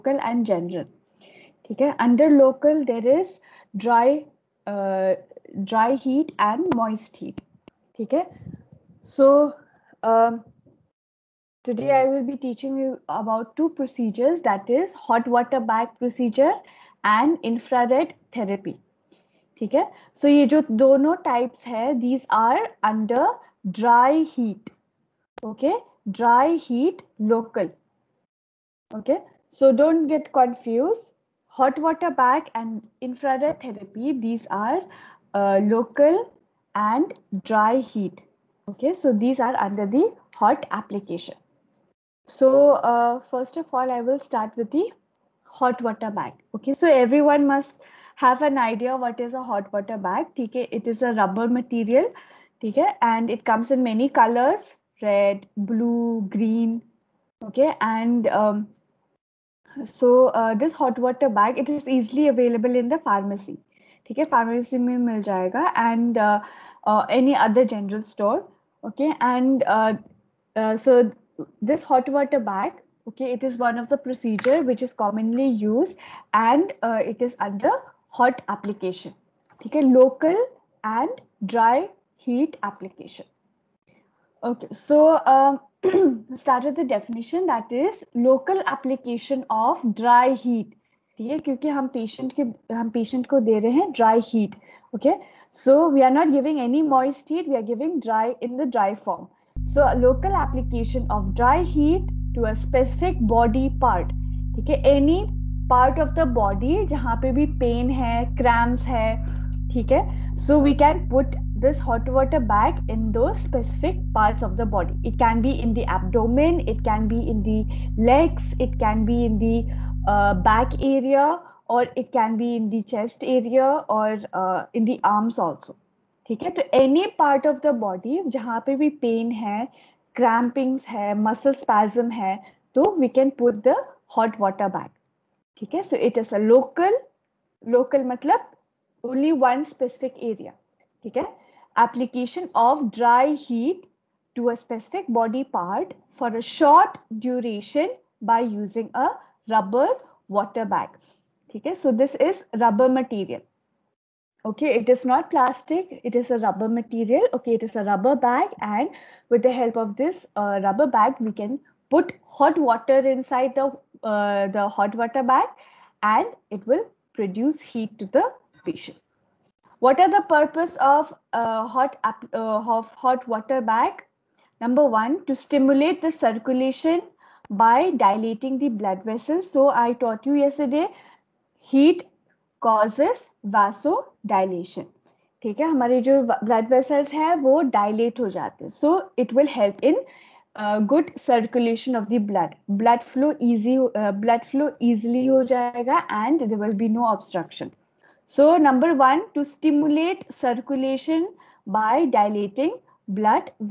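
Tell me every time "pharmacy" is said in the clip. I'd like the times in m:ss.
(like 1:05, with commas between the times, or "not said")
1:03.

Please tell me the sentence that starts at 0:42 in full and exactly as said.
So uh, first of all, I will start with the hot water bag.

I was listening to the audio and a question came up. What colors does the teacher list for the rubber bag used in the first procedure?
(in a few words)
Red, blue, green.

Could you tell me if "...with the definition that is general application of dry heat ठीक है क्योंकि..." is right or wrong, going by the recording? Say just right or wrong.
wrong.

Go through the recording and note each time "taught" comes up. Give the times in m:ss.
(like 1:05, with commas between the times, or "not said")
2:59.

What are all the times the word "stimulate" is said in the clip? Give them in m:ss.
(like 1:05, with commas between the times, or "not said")
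2:55, 3:19.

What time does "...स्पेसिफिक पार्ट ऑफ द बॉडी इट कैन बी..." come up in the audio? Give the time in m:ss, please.
1:53.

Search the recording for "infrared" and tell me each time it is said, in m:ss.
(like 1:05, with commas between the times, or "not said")
0:17, 0:33.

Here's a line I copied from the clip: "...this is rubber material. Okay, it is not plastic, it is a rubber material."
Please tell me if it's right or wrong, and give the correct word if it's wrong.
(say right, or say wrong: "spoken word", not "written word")
right.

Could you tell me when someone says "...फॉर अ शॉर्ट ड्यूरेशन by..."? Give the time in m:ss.
2:26.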